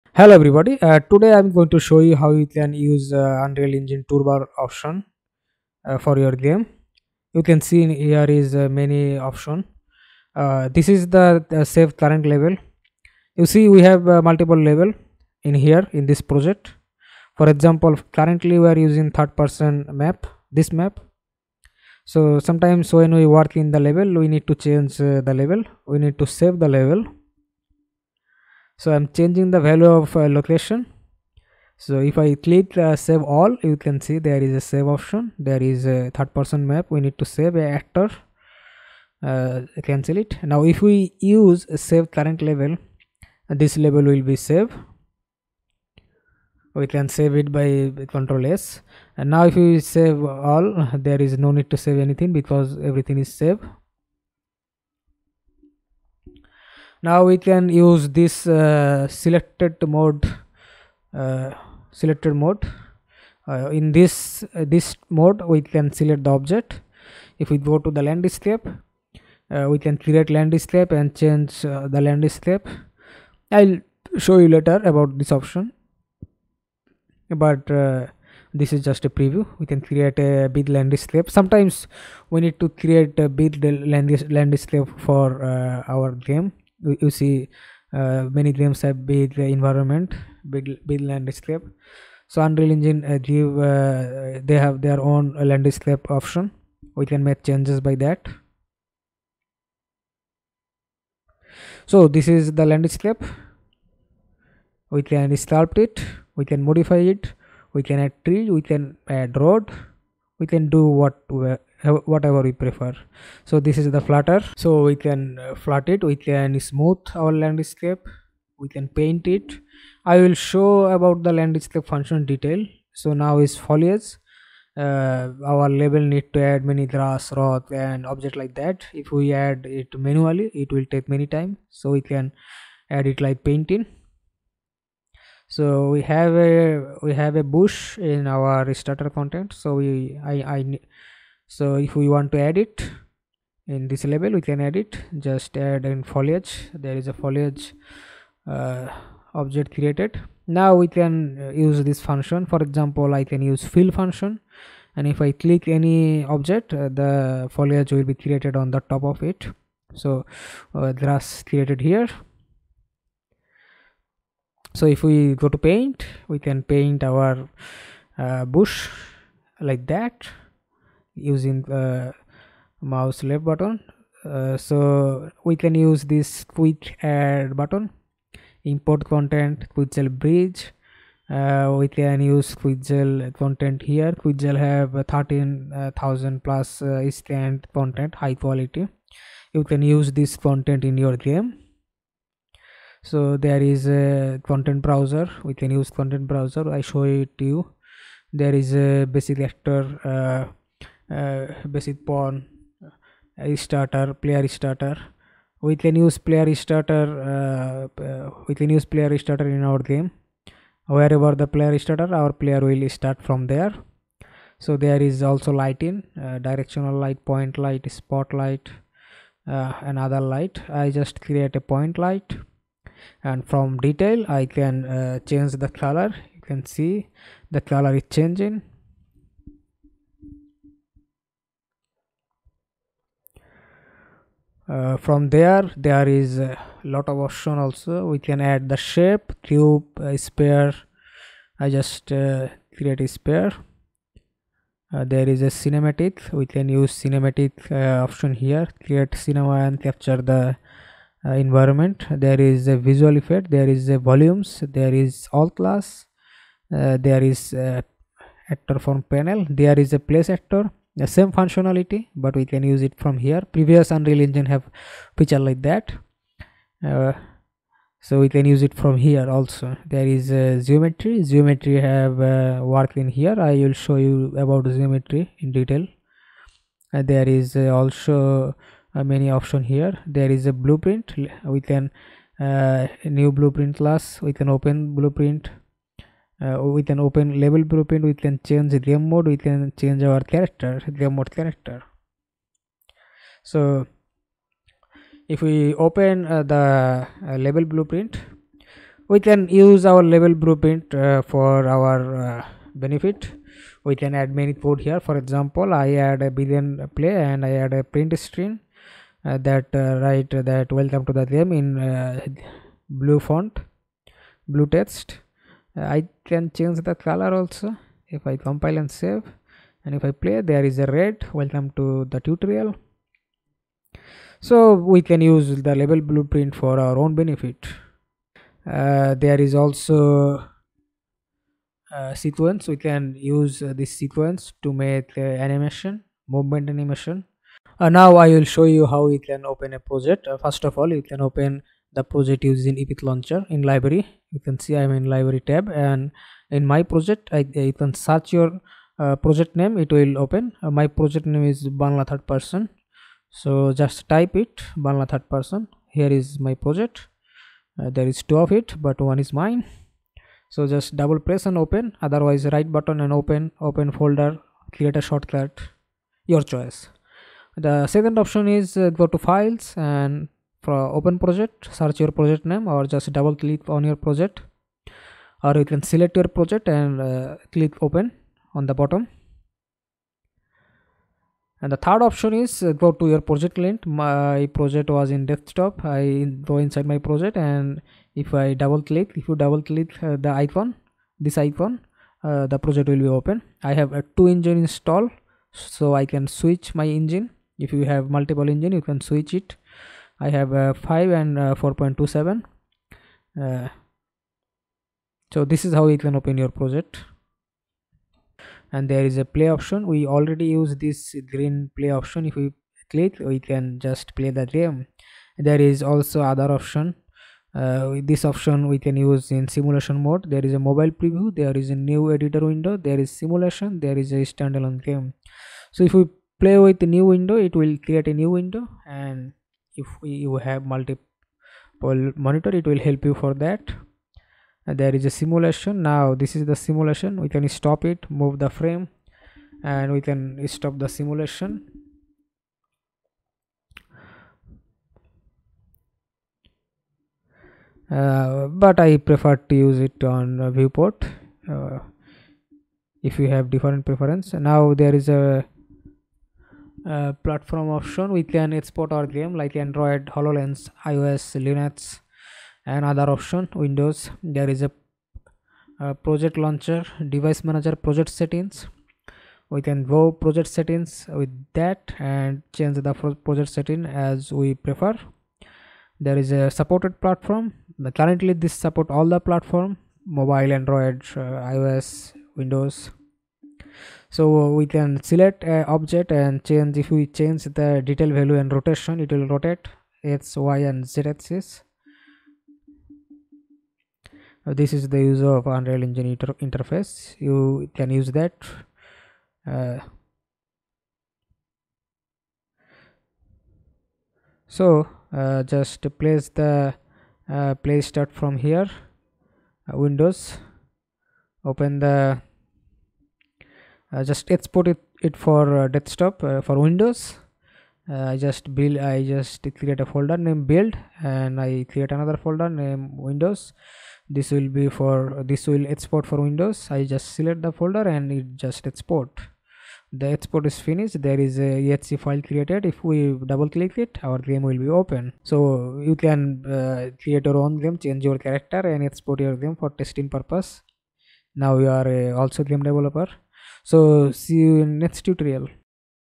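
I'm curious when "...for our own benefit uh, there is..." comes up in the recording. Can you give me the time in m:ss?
5:26.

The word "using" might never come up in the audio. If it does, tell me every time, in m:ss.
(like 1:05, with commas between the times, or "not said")
0:18, 2:51, 5:42.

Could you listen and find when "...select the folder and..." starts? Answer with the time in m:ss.
8:47.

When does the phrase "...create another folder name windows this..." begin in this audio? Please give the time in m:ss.
8:41.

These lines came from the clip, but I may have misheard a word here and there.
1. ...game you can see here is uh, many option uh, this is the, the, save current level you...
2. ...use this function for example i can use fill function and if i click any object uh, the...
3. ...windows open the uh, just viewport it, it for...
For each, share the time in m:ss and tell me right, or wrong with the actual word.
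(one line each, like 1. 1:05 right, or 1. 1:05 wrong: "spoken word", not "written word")
1. 0:06 right
2. 2:31 right
3. 8:29 wrong: "export", not "viewport".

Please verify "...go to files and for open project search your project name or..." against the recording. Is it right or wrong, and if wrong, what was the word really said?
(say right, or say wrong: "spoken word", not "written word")
right.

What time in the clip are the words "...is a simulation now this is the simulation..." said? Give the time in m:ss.
7:14.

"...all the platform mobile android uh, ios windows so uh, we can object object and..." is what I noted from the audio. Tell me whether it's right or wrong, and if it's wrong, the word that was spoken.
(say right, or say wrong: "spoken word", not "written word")
wrong: "select", not "object".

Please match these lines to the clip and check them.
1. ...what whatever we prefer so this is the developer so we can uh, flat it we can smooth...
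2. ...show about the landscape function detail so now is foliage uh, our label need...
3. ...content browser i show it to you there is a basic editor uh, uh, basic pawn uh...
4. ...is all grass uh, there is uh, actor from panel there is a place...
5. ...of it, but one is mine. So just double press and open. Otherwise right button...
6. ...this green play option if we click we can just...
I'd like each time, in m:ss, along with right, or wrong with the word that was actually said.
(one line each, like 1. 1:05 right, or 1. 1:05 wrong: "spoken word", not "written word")
1. 1:50 wrong: "flutter", not "developer"
2. 2:00 right
3. 3:15 wrong: "actor", not "editor"
4. 4:14 wrong: "class", not "grass"
5. 5:58 right
6. 6:50 right.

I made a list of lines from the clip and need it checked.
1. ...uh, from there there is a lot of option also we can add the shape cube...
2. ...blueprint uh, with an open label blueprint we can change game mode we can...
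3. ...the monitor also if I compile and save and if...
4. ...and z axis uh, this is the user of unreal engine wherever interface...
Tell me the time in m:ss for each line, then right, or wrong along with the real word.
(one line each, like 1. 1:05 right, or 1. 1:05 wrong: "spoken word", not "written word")
1. 3:54 right
2. 4:44 right
3. 5:16 wrong: "color", not "monitor"
4. 8:10 wrong: "inter", not "wherever".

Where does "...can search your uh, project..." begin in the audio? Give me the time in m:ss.
5:47.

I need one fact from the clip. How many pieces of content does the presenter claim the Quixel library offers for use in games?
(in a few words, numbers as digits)
13000 plus.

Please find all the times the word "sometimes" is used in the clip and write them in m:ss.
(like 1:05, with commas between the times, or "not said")
0:22, 1:21.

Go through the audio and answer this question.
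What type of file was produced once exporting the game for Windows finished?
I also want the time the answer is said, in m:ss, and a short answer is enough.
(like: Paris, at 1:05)
exe file, at 8:51.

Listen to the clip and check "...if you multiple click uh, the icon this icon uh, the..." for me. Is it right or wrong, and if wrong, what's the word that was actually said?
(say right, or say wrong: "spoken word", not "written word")
wrong: "double", not "multiple".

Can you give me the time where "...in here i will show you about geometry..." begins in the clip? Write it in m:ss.
4:32.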